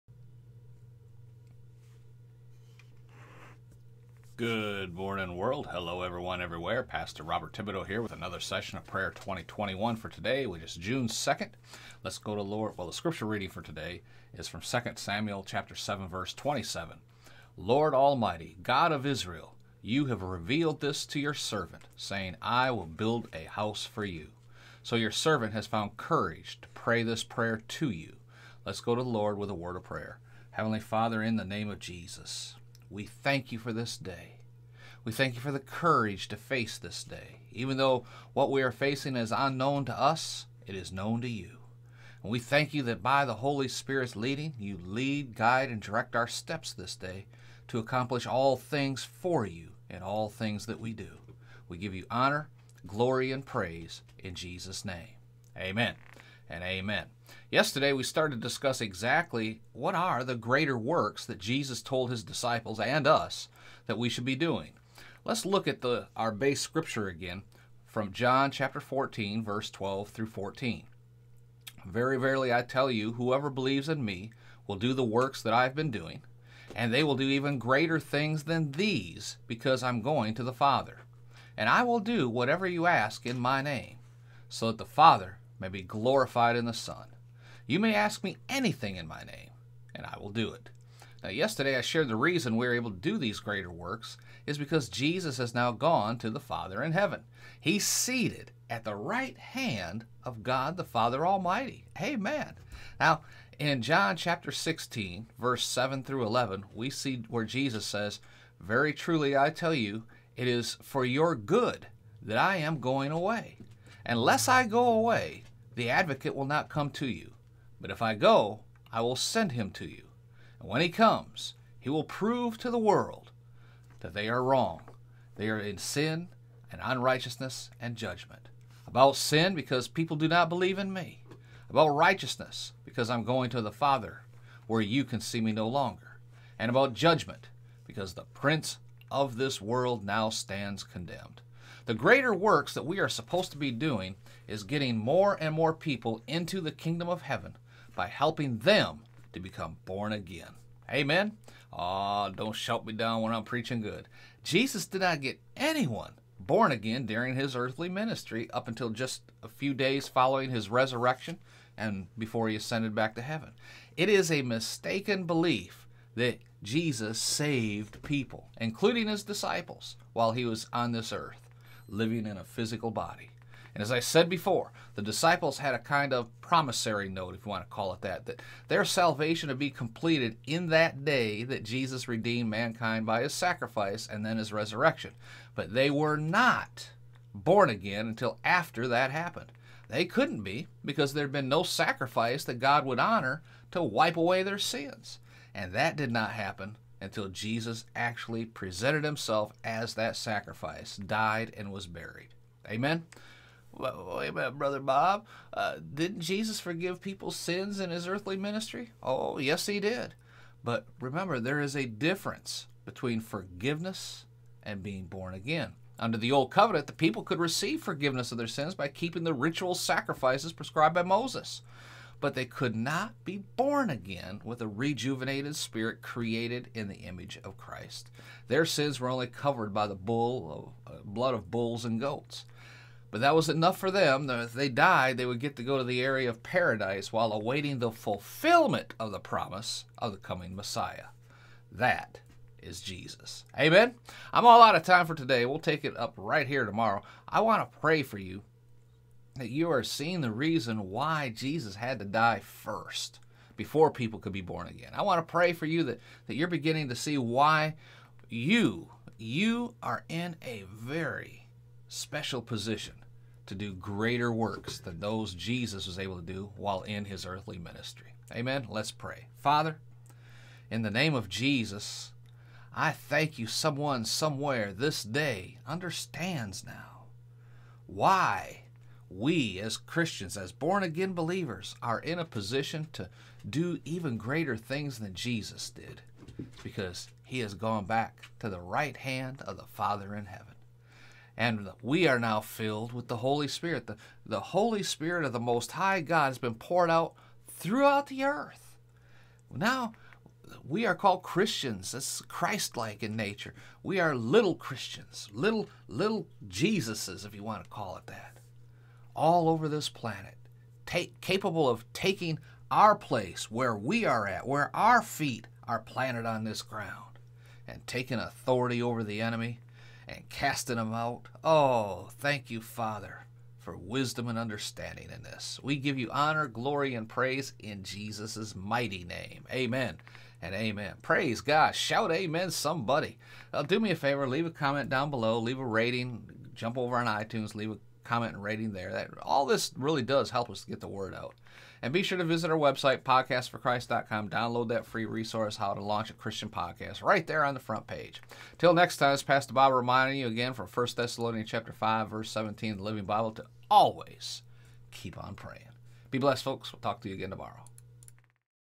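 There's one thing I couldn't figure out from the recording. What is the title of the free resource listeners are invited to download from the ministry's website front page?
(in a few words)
How to Launch a Christian Podcast.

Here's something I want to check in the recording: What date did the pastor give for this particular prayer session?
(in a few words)
June 2nd.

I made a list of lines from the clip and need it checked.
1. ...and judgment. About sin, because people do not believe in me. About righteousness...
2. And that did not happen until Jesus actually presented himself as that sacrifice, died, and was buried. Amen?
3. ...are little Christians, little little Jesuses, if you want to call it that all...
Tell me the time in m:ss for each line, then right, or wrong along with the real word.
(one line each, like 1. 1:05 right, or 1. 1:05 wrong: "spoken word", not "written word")
1. 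2:07 right
2. 3:15 right
3. 5:03 right.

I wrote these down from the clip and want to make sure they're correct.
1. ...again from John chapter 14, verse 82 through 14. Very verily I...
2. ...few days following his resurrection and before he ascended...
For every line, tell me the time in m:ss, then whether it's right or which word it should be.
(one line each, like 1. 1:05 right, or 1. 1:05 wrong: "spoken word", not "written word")
1. 1:07 wrong: "12", not "82"
2. 2:39 right.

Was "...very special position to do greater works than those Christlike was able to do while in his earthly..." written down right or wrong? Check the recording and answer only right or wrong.
wrong.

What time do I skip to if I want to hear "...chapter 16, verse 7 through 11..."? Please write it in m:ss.
1:44.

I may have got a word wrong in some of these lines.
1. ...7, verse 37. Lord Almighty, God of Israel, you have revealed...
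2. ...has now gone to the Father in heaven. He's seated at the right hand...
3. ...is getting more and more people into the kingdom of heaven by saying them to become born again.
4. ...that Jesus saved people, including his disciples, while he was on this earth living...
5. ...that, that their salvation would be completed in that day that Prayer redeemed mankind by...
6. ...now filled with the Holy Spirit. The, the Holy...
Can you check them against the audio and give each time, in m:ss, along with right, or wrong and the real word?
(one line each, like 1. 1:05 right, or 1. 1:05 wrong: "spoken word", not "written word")
1. 0:15 wrong: "27", not "37"
2. 1:35 right
3. 2:24 wrong: "helping", not "saying"
4. 2:46 right
5. 2:58 wrong: "Jesus", not "Prayer"
6. 4:52 right.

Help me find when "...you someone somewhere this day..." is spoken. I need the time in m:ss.
4:33.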